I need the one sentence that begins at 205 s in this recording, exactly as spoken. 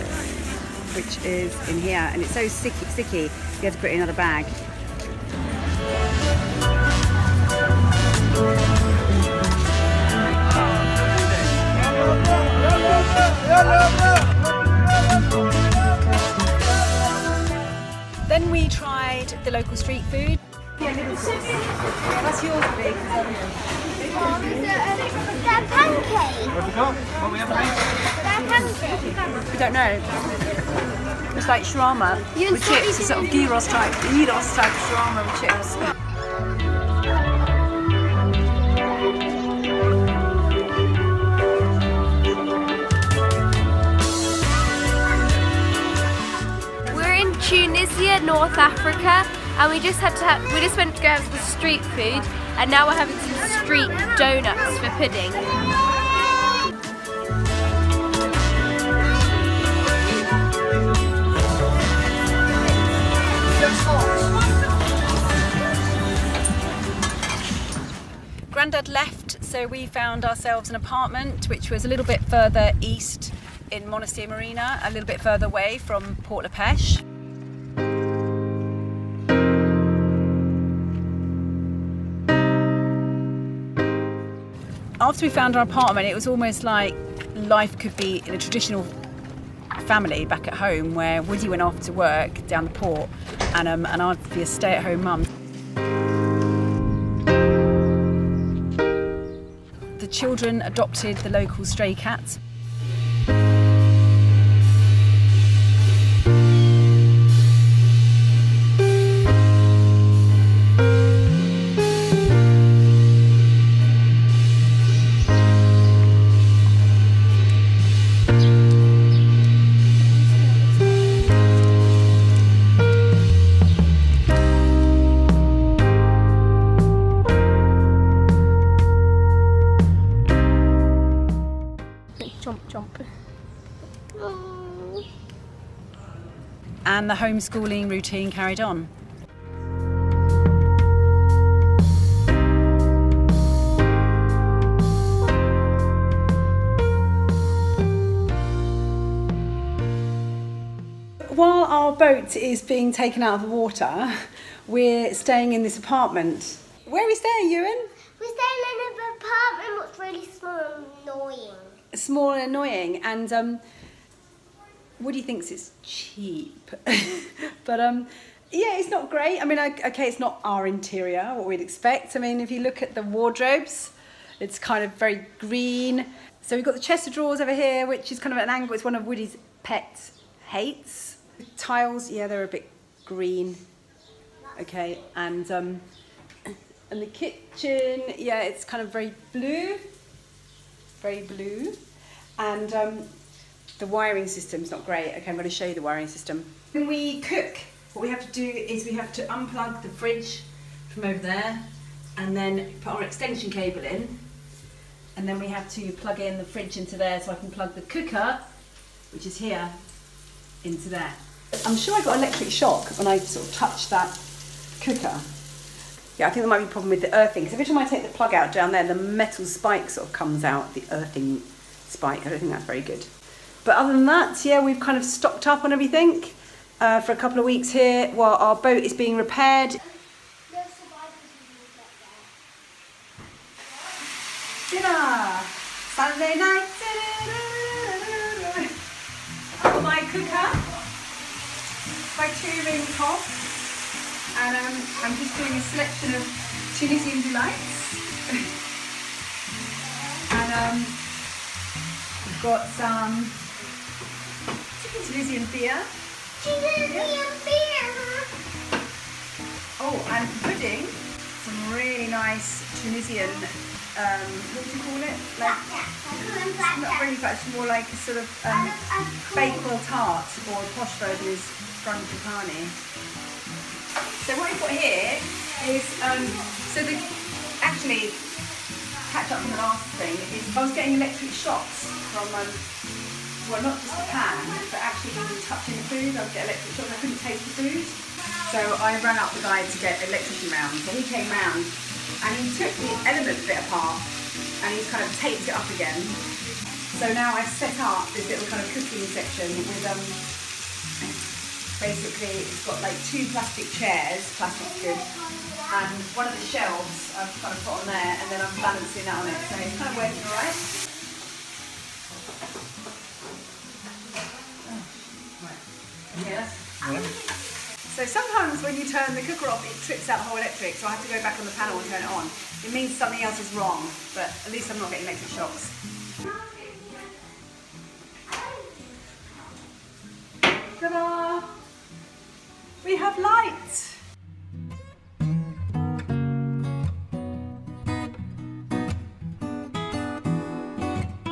And then we have to plug in the fridge into there so I can plug the cooker, which is here, into there.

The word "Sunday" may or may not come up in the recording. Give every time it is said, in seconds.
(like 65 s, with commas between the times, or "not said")
235 s.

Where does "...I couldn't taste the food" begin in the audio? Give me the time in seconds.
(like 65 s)
286 s.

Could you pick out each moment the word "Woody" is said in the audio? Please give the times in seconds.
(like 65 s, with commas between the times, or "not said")
91 s, 165 s, 179 s.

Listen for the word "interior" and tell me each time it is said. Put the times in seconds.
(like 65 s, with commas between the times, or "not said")
170 s.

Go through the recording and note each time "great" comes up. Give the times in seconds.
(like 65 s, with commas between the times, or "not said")
169 s, 194 s.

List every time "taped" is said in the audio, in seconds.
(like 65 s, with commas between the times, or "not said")
295 s.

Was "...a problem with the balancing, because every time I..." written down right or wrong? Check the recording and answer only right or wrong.
wrong.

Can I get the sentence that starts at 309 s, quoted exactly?
So it's kind of working alright.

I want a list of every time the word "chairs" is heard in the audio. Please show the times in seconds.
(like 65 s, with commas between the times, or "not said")
303 s.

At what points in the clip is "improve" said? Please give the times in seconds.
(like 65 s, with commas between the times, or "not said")
not said.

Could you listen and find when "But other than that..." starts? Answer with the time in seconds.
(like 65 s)
223 s.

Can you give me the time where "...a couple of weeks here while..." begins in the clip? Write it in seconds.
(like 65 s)
227 s.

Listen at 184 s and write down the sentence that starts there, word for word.
Okay, and um, and the kitchen, yeah, it's kind of very blue, very blue.